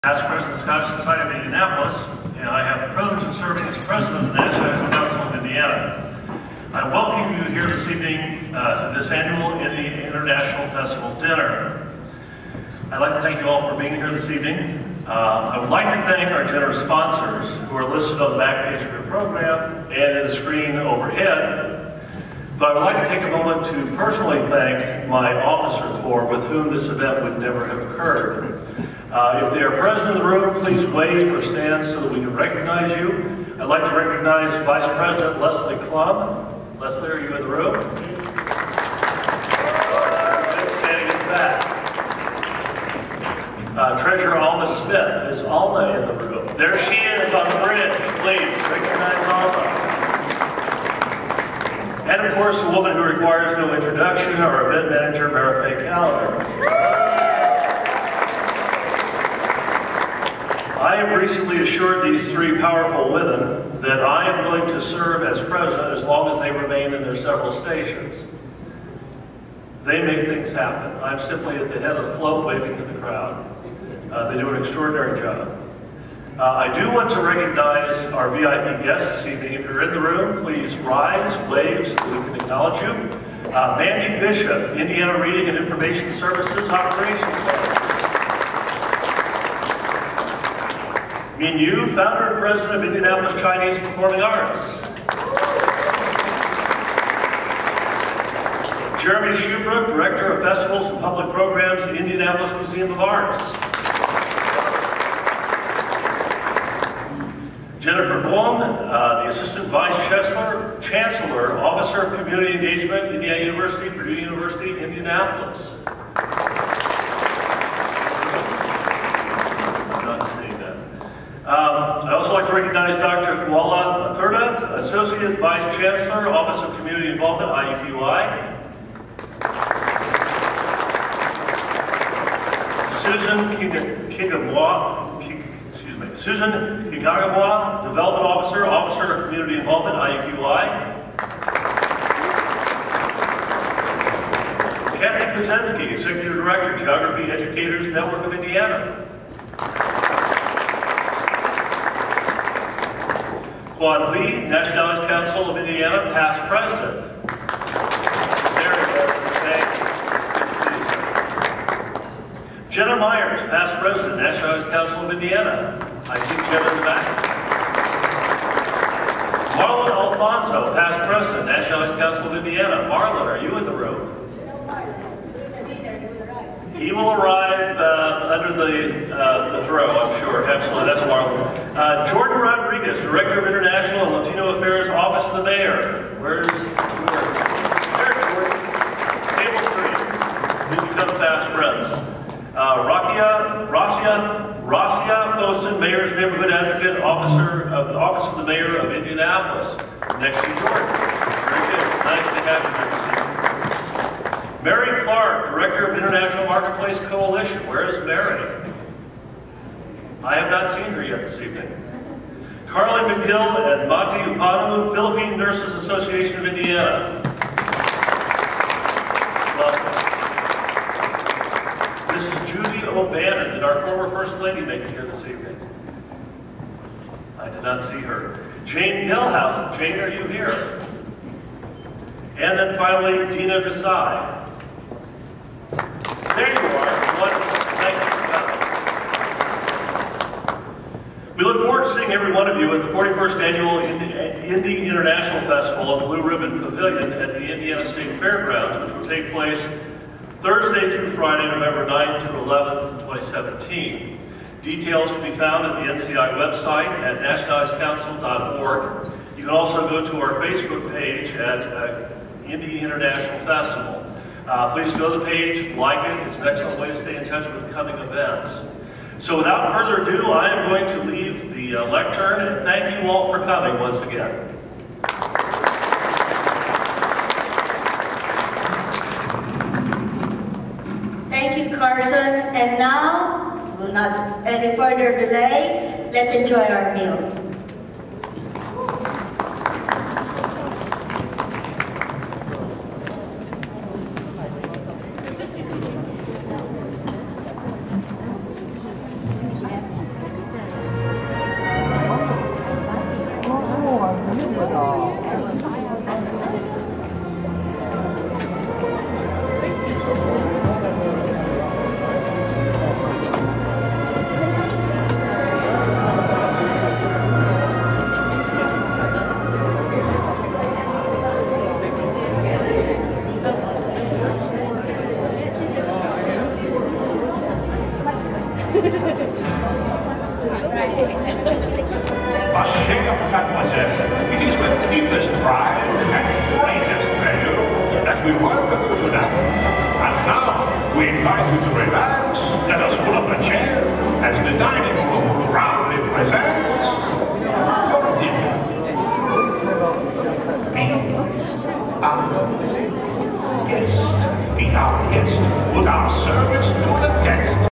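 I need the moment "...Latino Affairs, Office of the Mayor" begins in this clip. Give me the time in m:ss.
3:04.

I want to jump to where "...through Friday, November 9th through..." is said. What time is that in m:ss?
4:10.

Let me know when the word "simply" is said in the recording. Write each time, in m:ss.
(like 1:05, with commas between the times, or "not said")
1:11.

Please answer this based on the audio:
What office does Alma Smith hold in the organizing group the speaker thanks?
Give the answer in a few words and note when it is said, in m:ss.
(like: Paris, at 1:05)
Treasurer, at 0:44.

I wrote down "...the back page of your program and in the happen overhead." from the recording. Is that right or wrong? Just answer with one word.
wrong.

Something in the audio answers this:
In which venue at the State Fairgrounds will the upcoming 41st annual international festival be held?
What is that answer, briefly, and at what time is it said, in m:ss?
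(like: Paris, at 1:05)
Blue Ribbon Pavilion, at 4:06.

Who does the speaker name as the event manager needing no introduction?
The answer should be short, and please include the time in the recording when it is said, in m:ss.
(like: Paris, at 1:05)
Mara Faye Calendar, at 0:55.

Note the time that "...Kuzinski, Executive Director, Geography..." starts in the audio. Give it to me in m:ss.
2:25.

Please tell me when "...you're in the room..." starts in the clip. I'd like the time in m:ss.
1:19.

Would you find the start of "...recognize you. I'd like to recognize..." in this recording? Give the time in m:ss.
0:32.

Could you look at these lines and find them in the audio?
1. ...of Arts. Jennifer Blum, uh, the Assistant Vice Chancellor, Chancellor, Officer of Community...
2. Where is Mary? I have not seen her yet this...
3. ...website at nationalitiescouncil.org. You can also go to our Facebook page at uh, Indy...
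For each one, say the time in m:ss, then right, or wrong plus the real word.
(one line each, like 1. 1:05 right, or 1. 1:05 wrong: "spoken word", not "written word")
1. 1:42 right
2. 3:27 right
3. 4:16 right.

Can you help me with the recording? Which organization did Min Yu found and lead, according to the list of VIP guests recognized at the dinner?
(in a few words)
Indianapolis Chinese Performing Arts.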